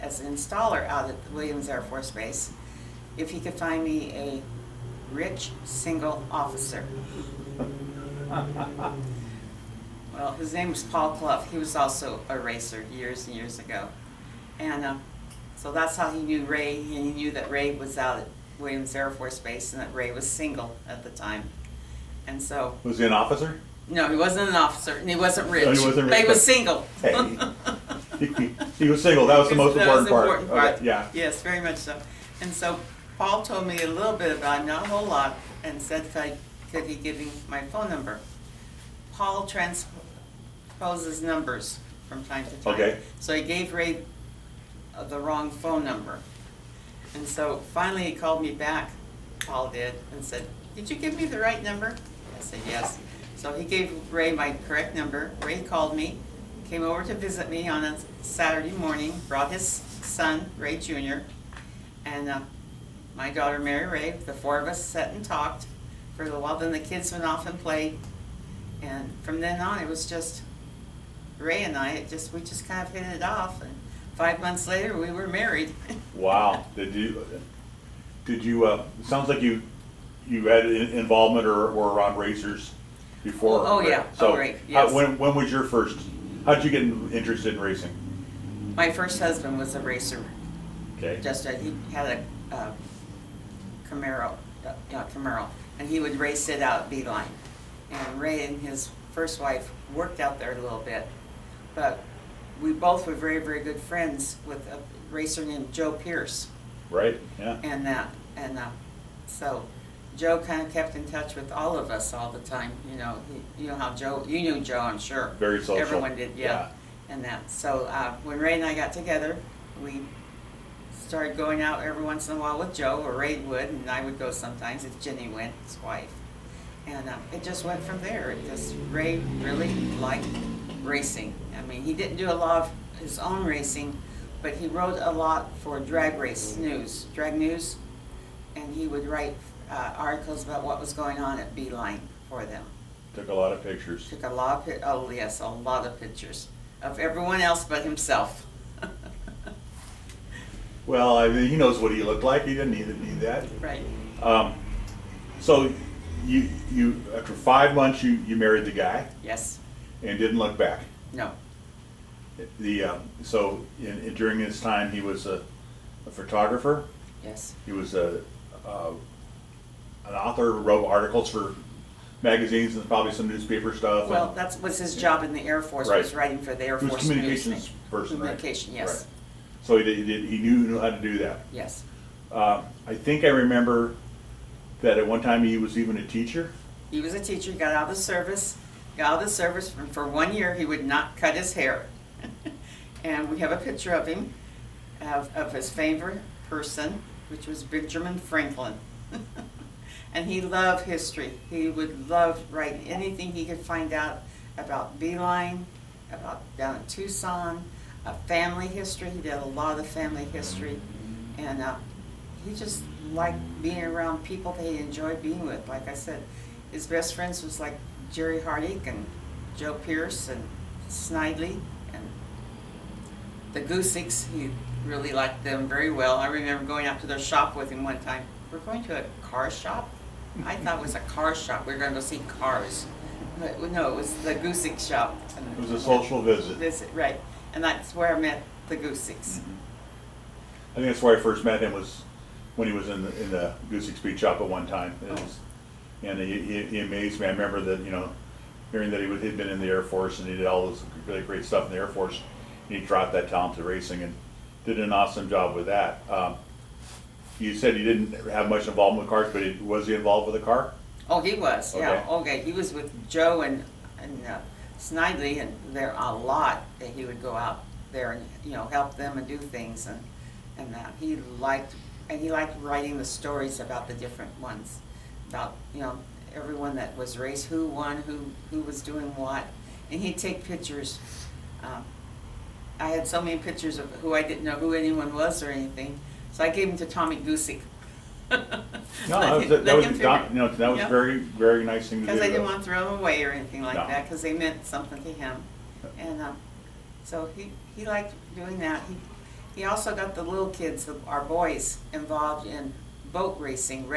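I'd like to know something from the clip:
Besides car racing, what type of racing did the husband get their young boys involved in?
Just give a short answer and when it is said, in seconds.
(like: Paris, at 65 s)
boat racing, at 303 s.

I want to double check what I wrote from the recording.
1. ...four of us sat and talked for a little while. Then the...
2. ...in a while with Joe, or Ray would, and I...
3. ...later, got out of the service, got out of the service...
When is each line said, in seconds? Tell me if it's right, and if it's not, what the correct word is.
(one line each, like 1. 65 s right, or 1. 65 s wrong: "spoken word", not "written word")
1. 64 s right
2. 122 s right
3. 187 s wrong: "teacher", not "later".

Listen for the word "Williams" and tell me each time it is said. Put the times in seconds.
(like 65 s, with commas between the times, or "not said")
1 s, 18 s.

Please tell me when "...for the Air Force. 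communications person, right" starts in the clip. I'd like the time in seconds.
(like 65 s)
176 s.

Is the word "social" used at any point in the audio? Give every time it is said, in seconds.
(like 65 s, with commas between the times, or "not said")
115 s, 235 s.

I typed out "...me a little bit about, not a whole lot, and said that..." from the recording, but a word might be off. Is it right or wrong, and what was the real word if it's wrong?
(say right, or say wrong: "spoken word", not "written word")
right.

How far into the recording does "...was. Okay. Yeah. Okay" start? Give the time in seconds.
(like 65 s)
261 s.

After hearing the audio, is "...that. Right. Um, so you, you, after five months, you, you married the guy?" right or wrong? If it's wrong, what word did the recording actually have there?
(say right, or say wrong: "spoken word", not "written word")
right.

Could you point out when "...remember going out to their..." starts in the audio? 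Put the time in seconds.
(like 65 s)
226 s.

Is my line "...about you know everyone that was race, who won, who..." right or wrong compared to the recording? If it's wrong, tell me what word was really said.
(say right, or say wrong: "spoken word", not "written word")
right.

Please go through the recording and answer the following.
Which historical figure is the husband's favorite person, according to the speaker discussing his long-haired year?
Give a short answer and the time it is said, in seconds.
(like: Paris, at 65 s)
Benjamin Franklin, at 197 s.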